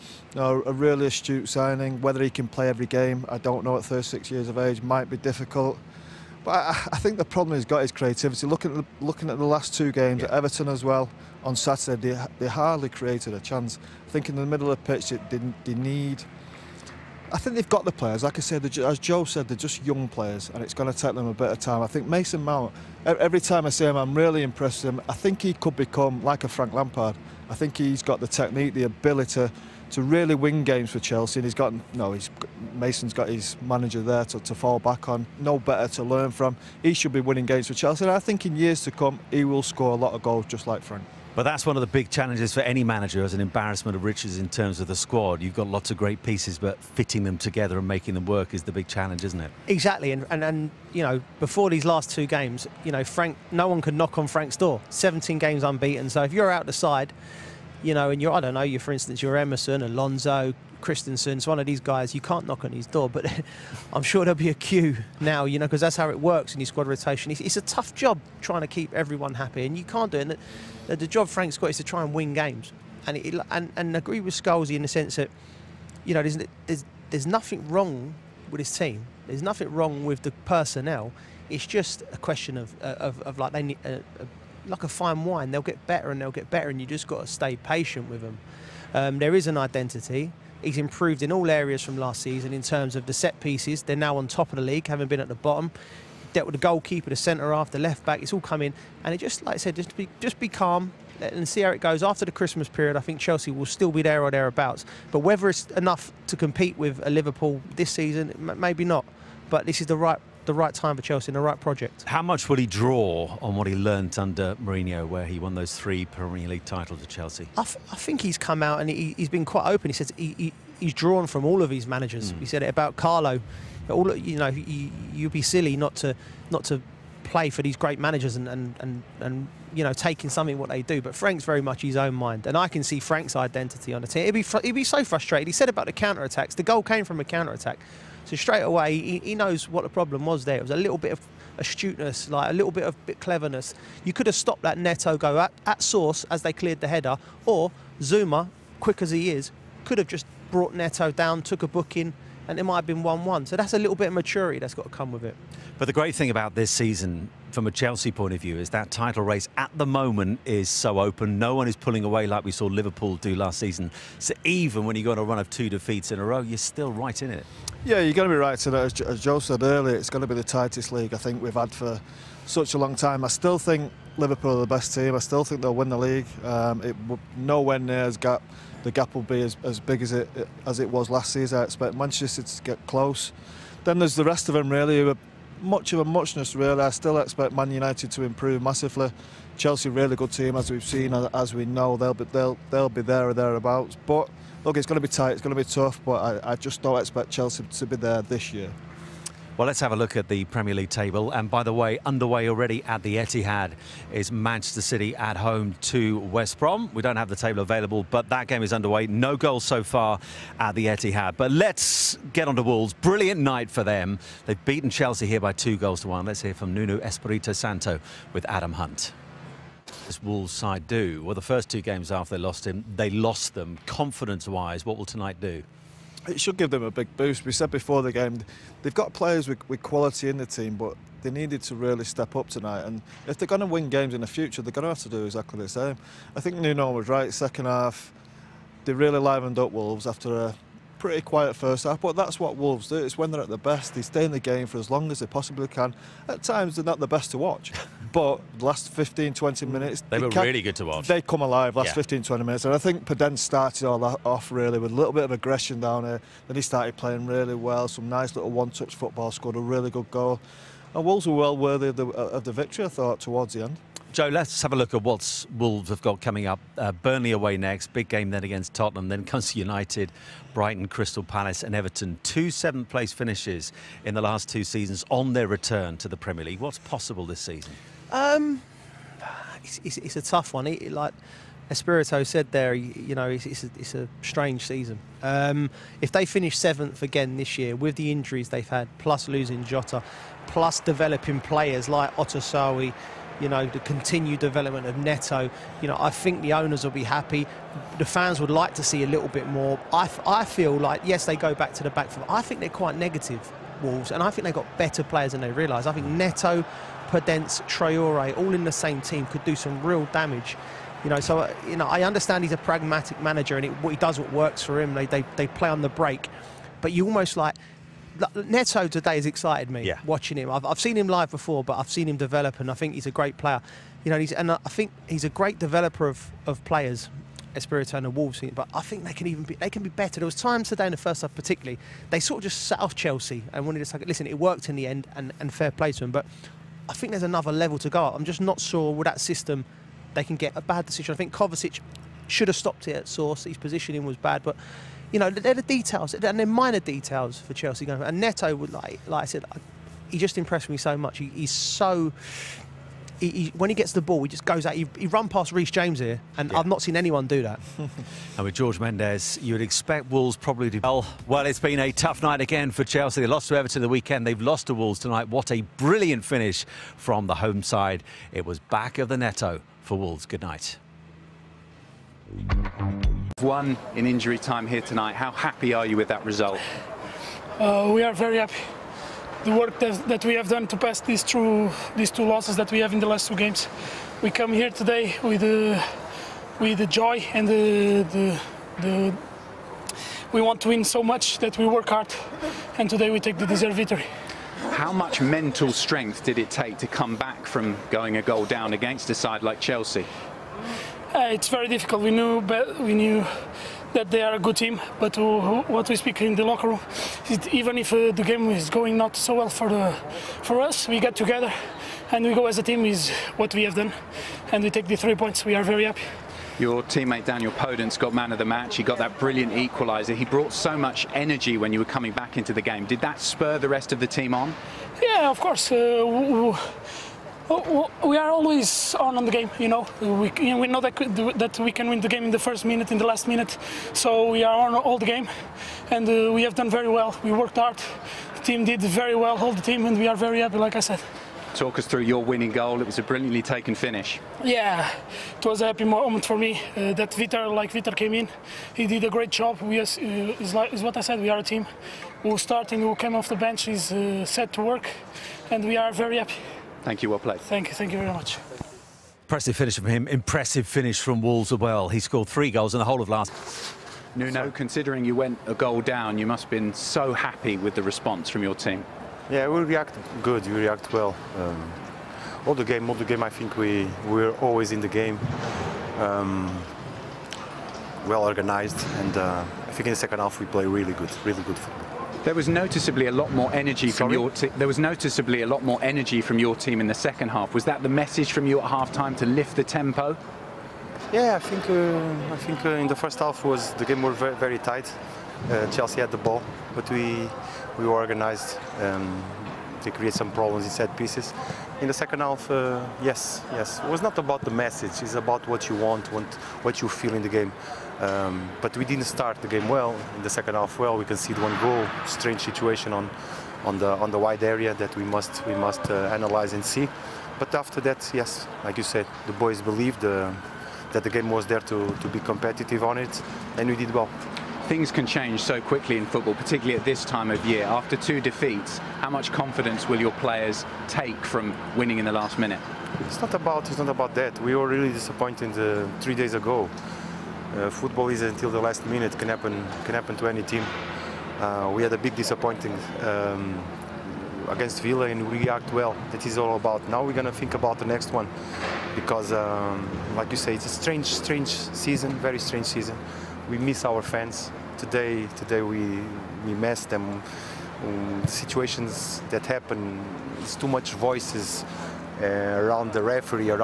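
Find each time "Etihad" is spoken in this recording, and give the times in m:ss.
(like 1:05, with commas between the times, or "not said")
3:23, 3:30.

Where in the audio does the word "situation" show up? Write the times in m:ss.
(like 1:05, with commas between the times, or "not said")
8:32, 9:18.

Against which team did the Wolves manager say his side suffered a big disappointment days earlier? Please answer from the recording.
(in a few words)
Villa.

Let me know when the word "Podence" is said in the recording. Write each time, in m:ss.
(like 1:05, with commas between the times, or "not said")
4:13, 5:07, 6:57.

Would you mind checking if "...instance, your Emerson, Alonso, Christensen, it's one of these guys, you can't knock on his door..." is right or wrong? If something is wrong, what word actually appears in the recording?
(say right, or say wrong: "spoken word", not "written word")
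right.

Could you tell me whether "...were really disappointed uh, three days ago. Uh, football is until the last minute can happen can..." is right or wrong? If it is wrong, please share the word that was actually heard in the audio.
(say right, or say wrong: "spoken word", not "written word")
right.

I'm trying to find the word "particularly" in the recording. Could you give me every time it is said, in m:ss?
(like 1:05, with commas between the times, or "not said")
5:31, 8:46.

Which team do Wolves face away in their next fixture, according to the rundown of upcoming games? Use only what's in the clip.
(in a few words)
Burnley.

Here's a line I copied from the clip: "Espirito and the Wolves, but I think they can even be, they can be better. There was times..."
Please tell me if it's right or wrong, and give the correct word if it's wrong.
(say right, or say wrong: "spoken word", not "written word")
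right.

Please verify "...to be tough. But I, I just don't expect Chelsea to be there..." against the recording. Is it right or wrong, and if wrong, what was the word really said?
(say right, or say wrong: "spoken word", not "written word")
right.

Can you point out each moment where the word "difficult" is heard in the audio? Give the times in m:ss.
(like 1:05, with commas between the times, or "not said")
0:05, 6:41.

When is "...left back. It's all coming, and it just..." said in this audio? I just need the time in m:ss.
1:37.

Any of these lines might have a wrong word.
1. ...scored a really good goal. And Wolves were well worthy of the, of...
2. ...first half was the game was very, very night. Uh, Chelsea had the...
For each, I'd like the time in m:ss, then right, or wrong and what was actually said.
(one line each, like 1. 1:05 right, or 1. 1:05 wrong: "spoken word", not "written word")
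1. 4:19 right
2. 8:12 wrong: "tight", not "night".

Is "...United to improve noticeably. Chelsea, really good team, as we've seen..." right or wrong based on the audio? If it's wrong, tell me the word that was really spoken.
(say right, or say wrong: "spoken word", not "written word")
wrong: "massively", not "noticeably".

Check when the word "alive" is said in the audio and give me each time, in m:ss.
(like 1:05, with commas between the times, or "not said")
4:11.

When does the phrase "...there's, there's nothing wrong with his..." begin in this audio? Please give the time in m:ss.
1:16.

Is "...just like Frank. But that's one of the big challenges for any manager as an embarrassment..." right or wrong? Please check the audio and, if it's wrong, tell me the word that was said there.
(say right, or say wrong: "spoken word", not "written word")
right.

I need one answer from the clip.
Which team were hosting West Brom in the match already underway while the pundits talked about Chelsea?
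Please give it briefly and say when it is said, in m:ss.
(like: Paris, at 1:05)
Manchester City, at 3:24.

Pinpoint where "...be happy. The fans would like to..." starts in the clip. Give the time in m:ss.
4:56.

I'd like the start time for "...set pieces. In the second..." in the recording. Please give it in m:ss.
8:20.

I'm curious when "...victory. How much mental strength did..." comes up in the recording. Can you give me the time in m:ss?
6:33.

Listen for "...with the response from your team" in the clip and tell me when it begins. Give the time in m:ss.
7:47.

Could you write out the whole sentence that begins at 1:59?
He says he, he, he's drawn from all of his managers.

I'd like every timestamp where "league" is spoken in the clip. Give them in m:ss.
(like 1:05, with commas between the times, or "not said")
1:34, 1:56, 2:50, 2:55, 3:20, 4:36.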